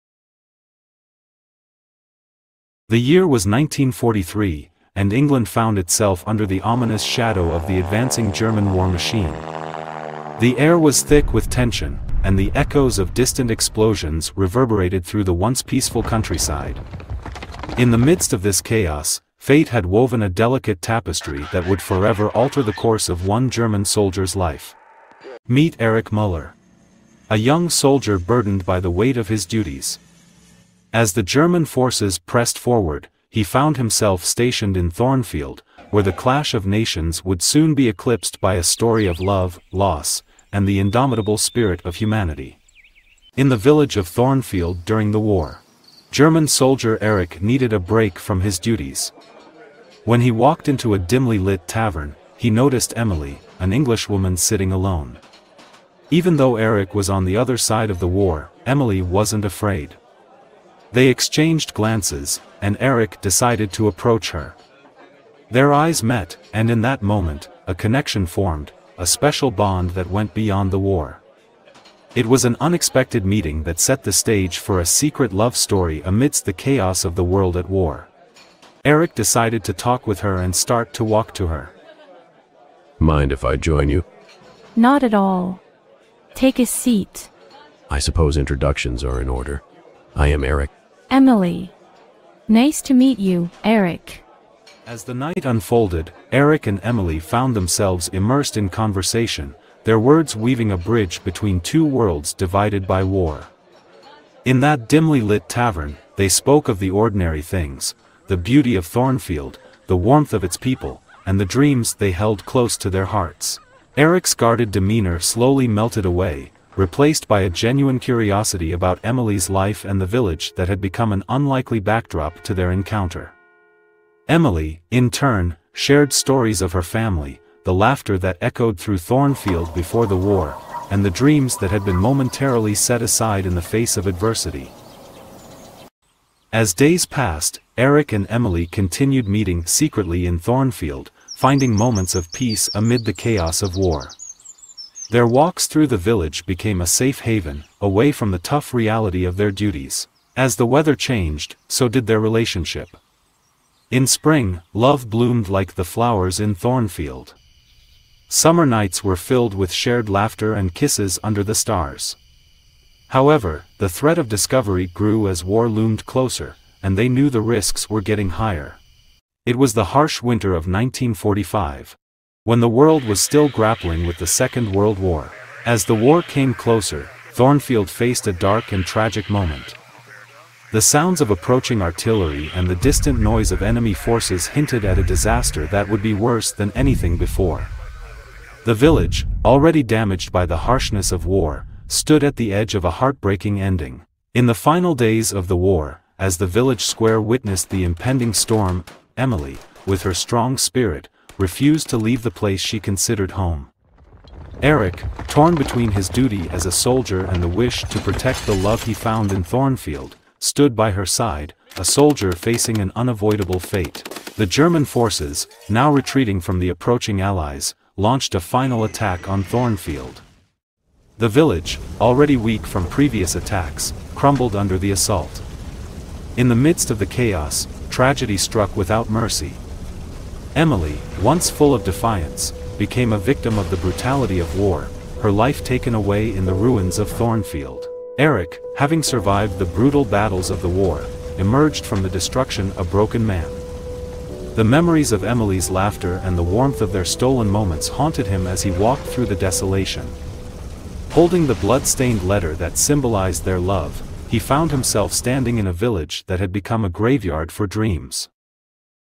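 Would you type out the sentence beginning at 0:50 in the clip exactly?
When he walked into a dimly lit tavern, he noticed Emily, an Englishwoman sitting alone.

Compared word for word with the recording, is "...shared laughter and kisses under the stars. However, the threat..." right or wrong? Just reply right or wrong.
right.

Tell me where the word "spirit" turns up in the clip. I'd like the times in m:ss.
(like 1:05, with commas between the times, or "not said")
0:41, 3:20.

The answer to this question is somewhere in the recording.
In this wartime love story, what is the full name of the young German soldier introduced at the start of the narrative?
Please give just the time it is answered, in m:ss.
0:25.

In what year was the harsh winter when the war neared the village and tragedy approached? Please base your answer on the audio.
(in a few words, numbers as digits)
1945.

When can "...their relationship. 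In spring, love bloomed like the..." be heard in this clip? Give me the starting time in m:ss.
2:32.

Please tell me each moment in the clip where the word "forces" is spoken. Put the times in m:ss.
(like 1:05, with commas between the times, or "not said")
0:31, 3:03, 3:34.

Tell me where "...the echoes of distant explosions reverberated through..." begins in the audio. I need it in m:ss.
0:12.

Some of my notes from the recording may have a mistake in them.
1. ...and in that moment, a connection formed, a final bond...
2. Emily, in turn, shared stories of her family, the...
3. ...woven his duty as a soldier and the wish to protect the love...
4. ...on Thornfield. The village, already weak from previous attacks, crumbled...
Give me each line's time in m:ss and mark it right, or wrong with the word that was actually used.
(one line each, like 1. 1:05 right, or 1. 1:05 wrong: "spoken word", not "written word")
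1. 1:06 wrong: "special", not "final"
2. 2:04 right
3. 3:25 wrong: "between", not "woven"
4. 3:39 right.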